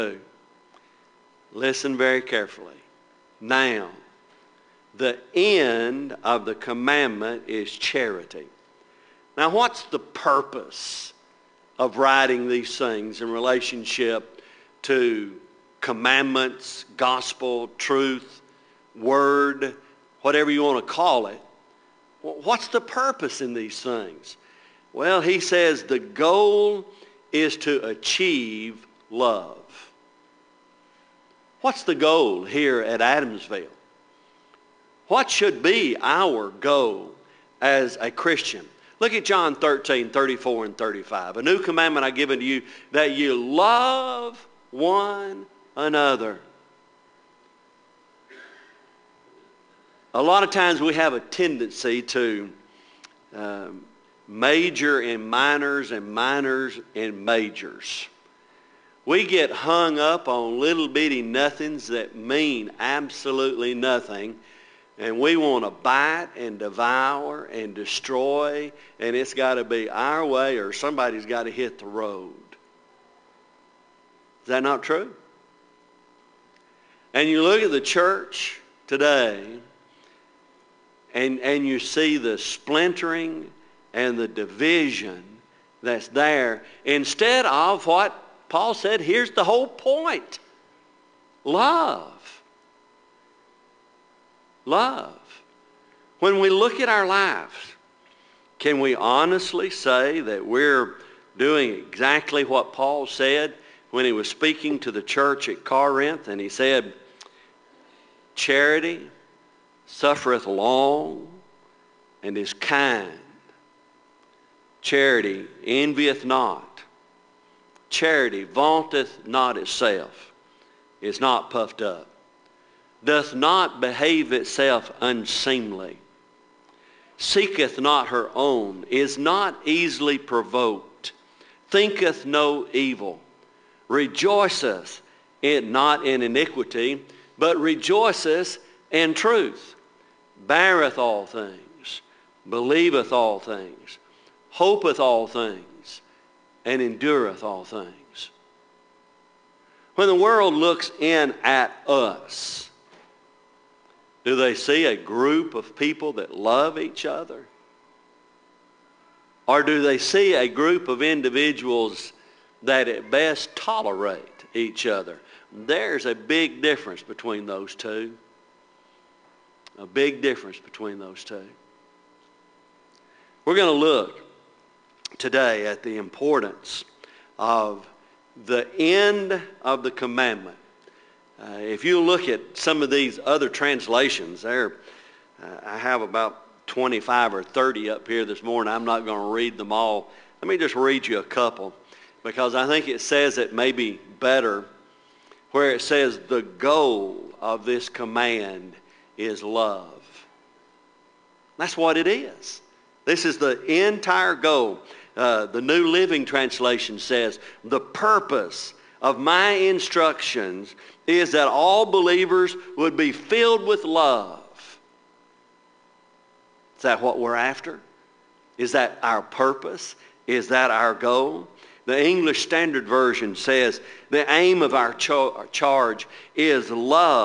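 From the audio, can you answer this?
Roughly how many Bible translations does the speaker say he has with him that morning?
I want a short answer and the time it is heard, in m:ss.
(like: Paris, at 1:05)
25 or 30, at 3:06.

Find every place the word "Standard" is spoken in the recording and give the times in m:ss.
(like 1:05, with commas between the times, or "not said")
3:42.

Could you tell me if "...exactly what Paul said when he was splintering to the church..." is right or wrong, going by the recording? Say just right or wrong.
wrong.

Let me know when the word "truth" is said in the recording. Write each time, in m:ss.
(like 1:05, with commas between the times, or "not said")
0:17, 2:19.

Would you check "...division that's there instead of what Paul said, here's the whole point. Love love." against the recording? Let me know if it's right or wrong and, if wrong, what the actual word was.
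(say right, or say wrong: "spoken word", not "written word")
right.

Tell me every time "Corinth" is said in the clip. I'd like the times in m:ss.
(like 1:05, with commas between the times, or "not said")
1:45.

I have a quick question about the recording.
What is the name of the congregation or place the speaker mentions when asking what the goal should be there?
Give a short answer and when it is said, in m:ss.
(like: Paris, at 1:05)
Adamsville, at 0:33.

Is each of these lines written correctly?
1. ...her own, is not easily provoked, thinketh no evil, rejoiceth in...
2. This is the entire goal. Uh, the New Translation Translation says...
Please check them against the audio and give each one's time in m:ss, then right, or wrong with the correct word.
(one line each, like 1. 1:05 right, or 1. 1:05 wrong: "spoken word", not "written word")
1. 2:08 right
2. 3:23 wrong: "Living", not "Translation".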